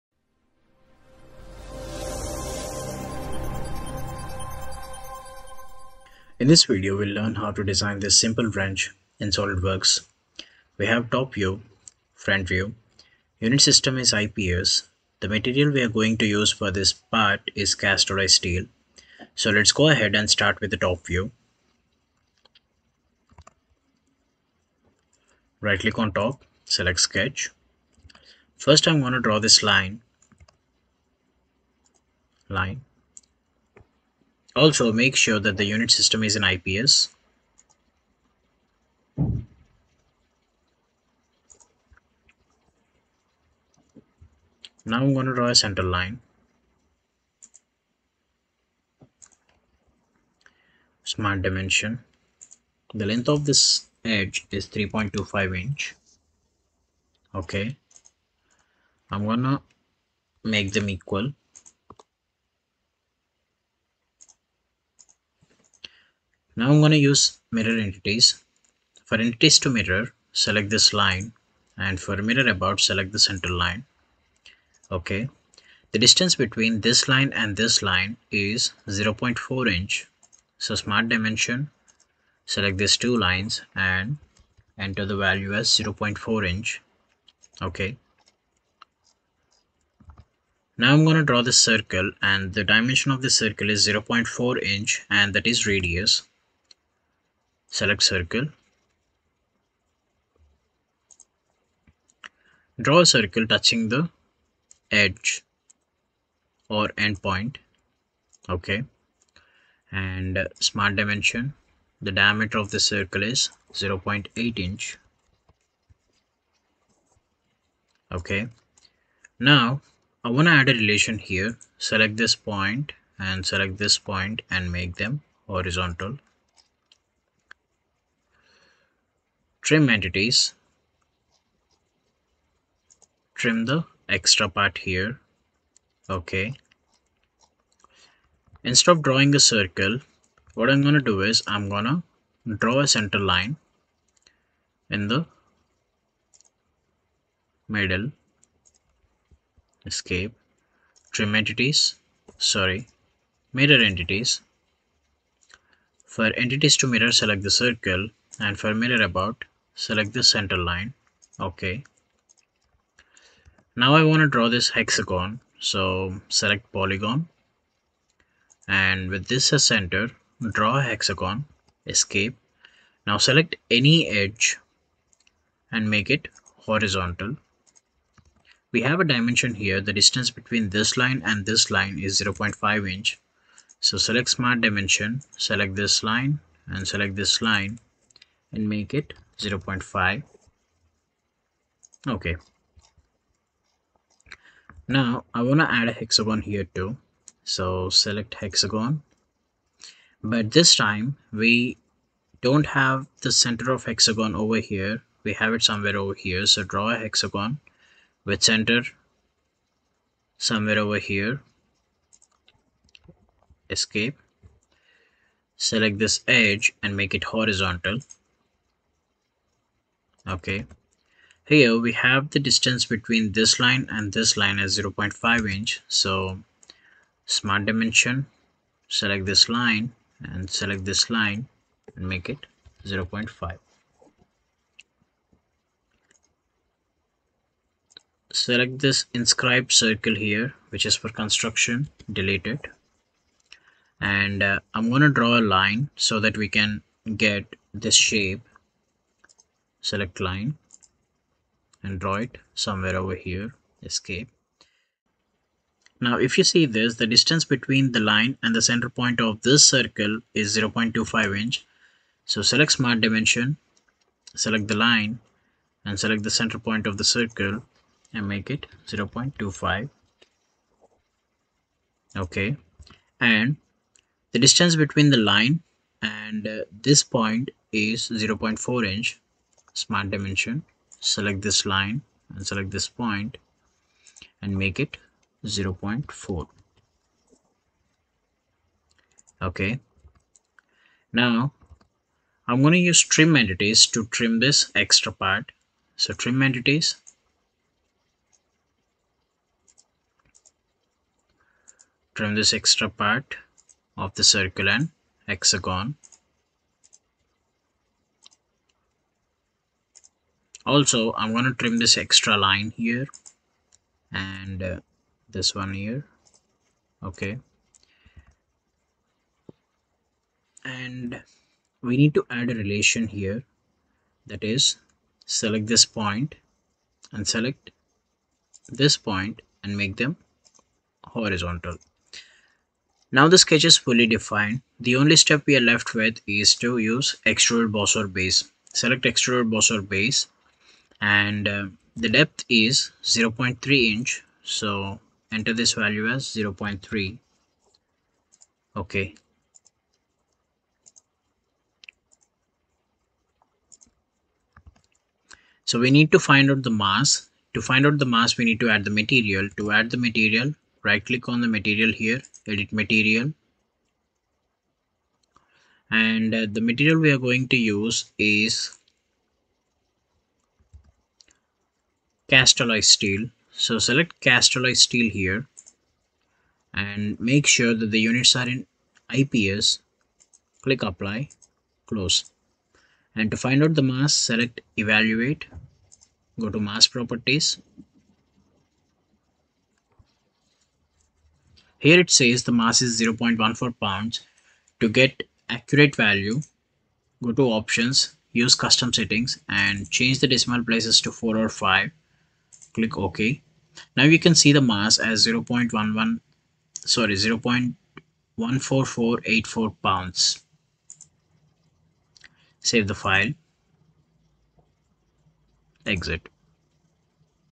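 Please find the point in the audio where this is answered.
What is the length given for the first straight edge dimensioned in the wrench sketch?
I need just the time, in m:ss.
0:54.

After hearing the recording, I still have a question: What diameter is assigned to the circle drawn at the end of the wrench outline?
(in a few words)
0.8 inch.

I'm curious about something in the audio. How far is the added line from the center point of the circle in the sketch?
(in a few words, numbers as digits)
0.25 inch.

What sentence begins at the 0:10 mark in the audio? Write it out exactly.
We have top view, front view, unit system is IPS.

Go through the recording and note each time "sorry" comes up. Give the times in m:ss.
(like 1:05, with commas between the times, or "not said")
2:32, 6:46.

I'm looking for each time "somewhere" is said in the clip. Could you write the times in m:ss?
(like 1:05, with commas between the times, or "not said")
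3:25, 3:30, 4:12.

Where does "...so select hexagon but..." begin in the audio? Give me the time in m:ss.
3:17.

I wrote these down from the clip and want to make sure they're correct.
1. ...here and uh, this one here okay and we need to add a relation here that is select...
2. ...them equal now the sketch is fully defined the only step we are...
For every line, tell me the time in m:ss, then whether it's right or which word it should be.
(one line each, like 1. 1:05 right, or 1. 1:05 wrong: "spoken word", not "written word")
1. 5:12 right
2. 5:30 wrong: "horizontal", not "equal".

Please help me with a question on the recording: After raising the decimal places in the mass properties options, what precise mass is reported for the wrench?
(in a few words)
0.14484 pounds.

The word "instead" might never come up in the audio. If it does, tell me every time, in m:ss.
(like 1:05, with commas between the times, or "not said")
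2:18.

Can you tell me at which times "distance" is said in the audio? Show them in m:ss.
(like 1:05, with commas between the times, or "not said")
1:15, 2:59, 3:42, 4:17, 4:34.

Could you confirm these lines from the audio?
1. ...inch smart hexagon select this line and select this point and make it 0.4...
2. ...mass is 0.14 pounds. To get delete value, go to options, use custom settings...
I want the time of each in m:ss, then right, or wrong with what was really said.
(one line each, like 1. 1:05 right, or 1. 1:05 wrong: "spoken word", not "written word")
1. 4:38 wrong: "dimension", not "hexagon"
2. 6:32 wrong: "accurate", not "delete".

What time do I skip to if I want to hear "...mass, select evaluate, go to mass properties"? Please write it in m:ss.
6:23.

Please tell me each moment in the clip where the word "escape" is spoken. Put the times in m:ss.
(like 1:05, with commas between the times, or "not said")
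2:29, 2:51, 3:33, 4:13.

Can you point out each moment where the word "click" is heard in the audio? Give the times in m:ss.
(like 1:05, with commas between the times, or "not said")
0:25, 6:01, 6:20, 6:42.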